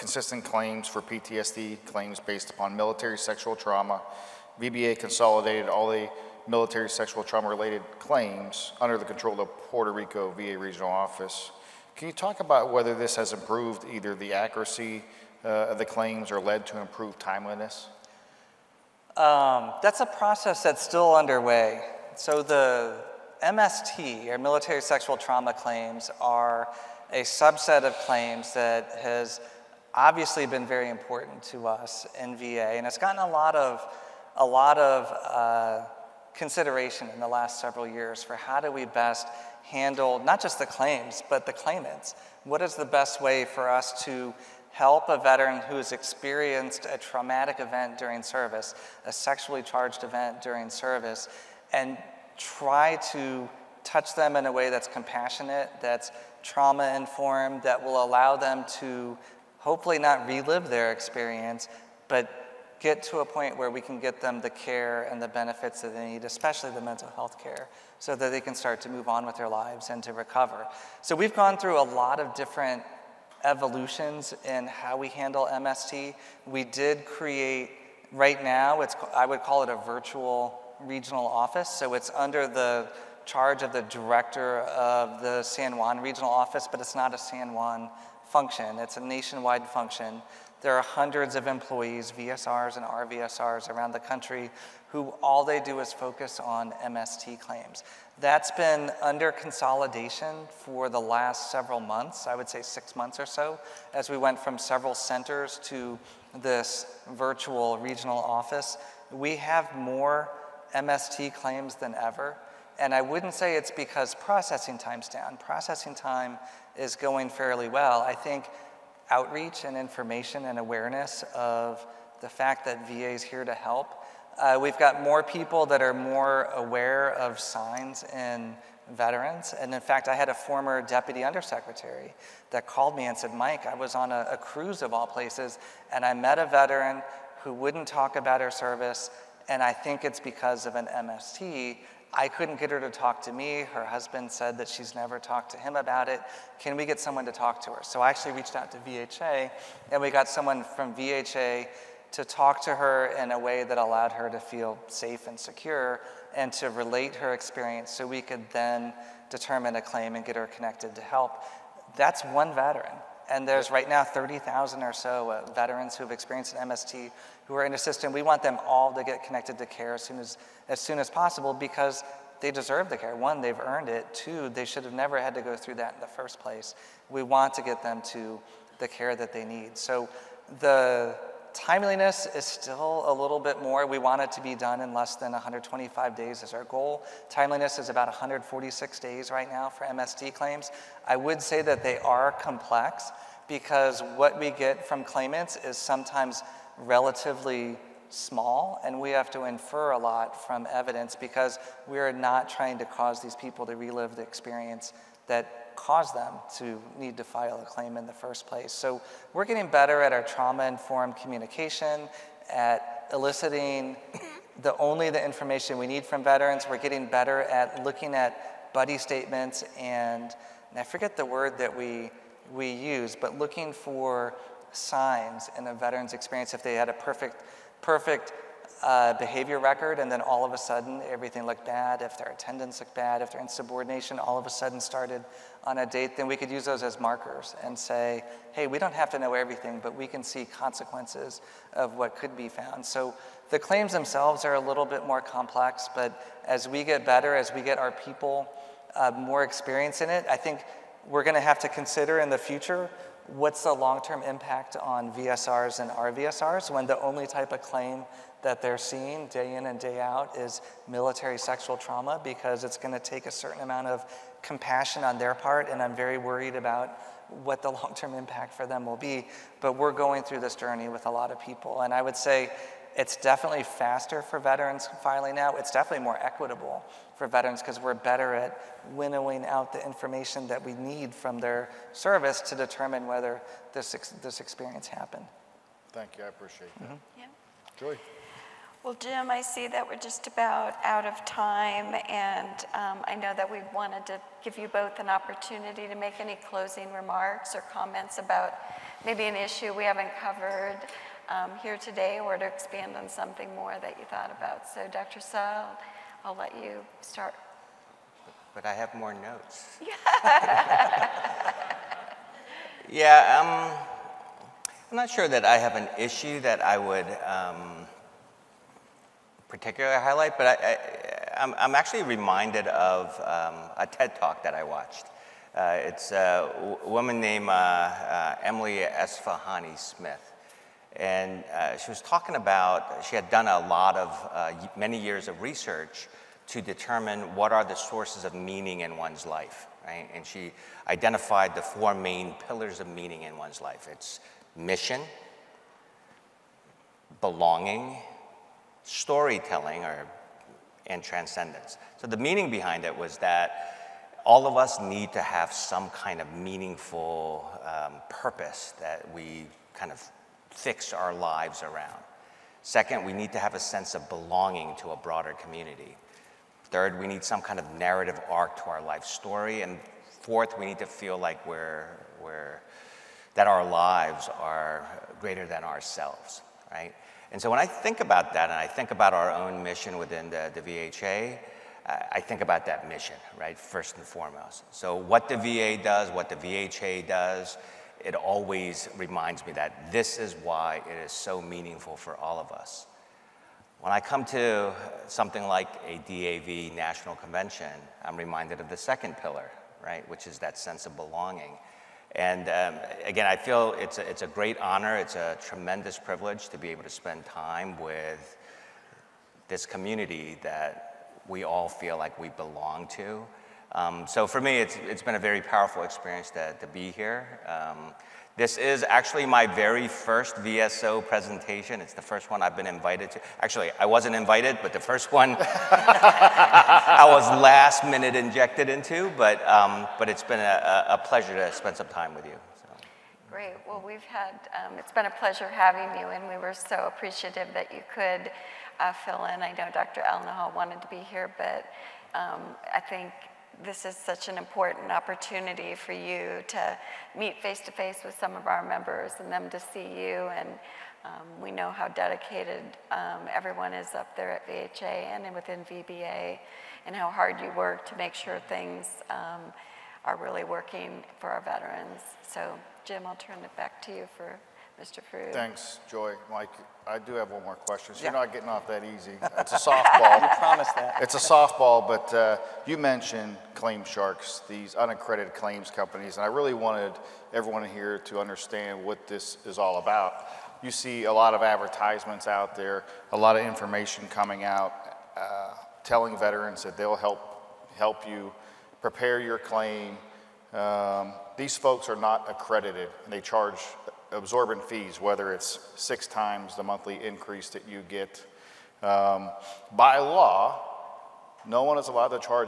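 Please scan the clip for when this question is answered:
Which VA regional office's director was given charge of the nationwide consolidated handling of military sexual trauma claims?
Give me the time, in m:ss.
0:09.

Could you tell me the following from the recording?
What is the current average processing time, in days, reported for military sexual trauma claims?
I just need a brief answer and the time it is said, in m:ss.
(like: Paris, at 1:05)
146 days, at 3:08.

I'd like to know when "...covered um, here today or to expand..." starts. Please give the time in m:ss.
5:00.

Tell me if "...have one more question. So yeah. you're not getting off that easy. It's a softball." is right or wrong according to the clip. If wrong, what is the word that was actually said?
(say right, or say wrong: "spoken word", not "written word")
right.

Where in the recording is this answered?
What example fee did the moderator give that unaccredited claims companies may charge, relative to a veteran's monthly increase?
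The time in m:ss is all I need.
8:15.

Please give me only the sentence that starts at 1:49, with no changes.
We have more MST claims than ever.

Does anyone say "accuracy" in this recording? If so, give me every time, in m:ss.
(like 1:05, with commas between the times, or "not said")
0:14.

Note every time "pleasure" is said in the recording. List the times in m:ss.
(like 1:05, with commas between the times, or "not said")
7:10, 7:15.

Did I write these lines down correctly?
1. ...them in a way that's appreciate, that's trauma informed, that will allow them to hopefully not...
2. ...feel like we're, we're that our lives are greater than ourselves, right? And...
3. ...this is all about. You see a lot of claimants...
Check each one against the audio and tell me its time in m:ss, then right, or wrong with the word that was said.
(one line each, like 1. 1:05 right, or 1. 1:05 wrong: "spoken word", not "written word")
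1. 0:54 wrong: "compassionate", not "appreciate"
2. 6:10 right
3. 7:59 wrong: "advertisements", not "claimants".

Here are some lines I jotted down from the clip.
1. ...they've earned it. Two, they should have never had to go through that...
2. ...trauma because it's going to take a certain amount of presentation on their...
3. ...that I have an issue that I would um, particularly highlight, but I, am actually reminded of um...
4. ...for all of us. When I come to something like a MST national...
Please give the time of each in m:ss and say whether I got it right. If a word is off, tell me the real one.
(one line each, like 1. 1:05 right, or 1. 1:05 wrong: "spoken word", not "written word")
1. 2:53 right
2. 4:21 wrong: "compassion", not "presentation"
3. 5:15 right
4. 6:31 wrong: "DAV", not "MST".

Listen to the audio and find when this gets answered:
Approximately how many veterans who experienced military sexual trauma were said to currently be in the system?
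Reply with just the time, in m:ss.
2:44.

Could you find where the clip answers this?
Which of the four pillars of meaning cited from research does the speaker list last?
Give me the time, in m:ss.
5:51.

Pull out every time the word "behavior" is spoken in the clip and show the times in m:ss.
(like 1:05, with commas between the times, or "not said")
3:49.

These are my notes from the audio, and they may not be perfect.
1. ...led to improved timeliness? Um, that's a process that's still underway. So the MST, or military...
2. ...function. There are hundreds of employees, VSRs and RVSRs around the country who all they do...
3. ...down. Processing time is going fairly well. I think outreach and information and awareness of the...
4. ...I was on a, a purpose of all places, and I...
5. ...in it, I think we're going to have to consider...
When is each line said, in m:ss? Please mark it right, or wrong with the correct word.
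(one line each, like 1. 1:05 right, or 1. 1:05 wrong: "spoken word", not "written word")
1. 0:16 right
2. 1:29 right
3. 1:55 right
4. 2:13 wrong: "cruise", not "purpose"
5. 4:10 right.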